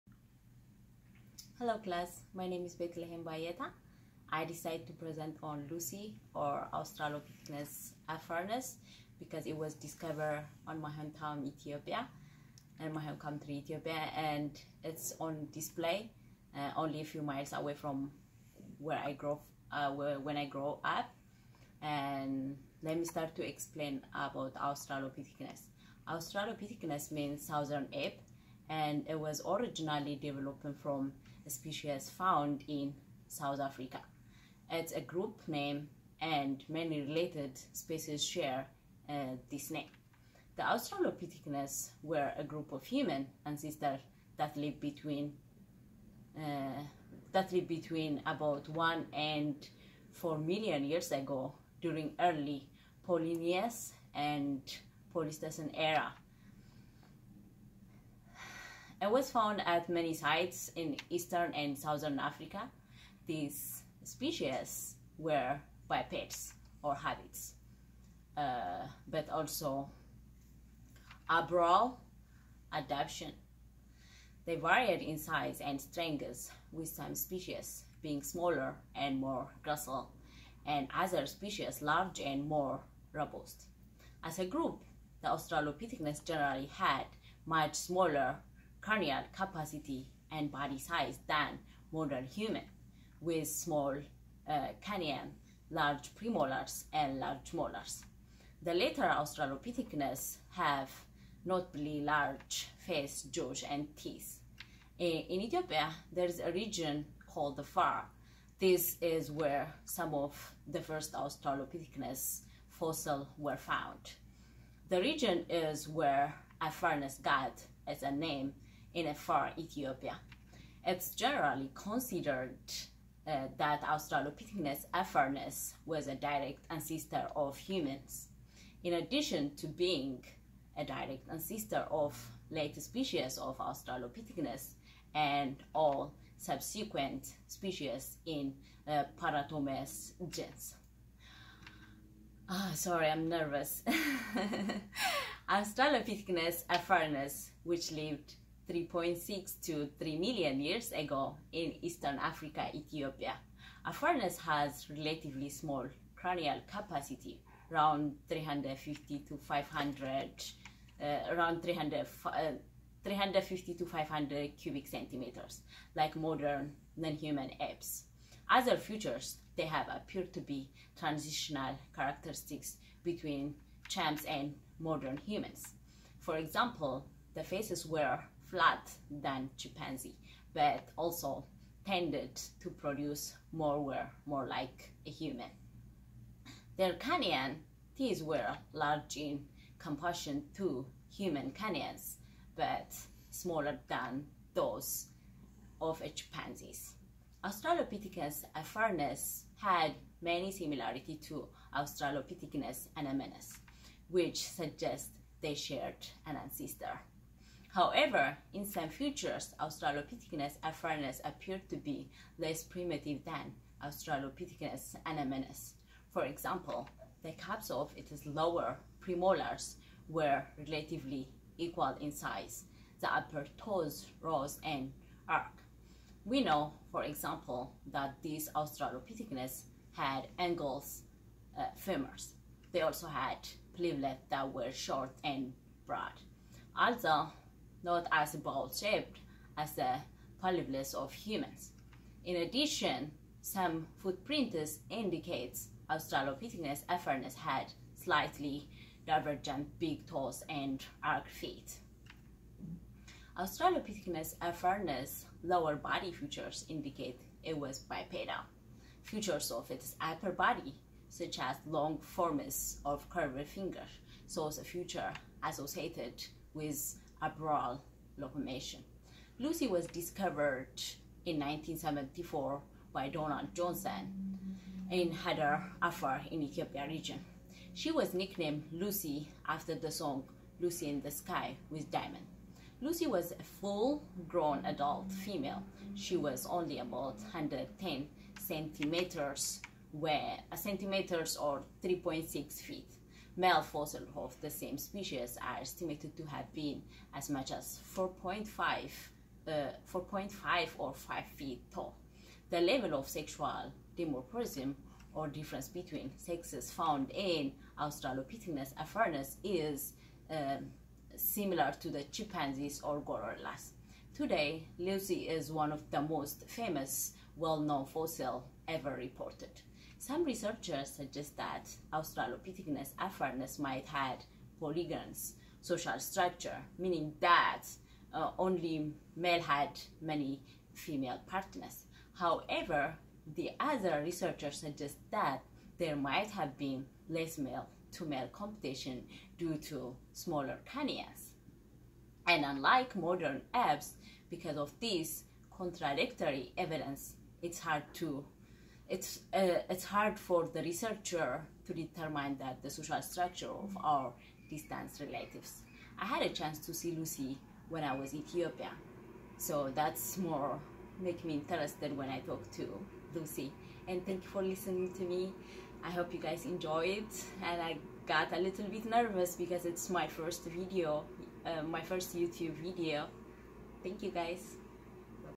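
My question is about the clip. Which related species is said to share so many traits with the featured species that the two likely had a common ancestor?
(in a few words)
Australopithecus anamensis.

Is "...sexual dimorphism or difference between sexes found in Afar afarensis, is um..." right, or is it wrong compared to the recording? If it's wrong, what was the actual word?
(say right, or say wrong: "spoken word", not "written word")
wrong: "Australopithecus", not "Afar".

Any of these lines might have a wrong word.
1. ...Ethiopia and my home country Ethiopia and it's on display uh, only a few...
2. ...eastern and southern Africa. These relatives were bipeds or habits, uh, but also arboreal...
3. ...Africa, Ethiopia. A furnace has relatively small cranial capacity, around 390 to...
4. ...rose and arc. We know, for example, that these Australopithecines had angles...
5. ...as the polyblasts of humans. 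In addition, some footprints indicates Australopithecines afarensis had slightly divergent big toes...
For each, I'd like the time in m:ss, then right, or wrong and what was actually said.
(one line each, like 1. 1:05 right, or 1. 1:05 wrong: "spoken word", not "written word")
1. 0:11 right
2. 1:01 wrong: "species", not "relatives"
3. 2:32 wrong: "350", not "390"
4. 3:44 right
5. 3:59 right.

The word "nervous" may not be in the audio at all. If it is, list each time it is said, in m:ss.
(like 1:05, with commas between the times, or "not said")
2:23, 6:08.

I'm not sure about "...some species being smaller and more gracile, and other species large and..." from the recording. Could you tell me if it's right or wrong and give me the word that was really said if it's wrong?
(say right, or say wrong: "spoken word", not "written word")
right.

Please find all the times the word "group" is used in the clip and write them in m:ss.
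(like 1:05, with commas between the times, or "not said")
0:35, 0:42, 1:24.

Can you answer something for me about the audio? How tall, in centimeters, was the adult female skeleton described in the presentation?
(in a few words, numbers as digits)
110 centimeters.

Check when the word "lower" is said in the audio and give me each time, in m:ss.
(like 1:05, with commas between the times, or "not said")
3:38, 4:15.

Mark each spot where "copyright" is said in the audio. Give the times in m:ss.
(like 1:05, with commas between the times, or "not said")
not said.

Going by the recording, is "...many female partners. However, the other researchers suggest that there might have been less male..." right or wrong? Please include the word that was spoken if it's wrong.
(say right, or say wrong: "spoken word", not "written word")
right.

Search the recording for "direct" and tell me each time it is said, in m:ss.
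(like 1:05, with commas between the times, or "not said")
2:06, 2:10.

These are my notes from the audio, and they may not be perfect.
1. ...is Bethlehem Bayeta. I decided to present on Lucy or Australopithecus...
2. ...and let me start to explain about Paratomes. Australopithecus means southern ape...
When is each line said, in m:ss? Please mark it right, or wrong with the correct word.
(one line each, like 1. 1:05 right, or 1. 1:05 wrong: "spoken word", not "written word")
1. 0:02 right
2. 0:21 wrong: "Australopithecus", not "Paratomes".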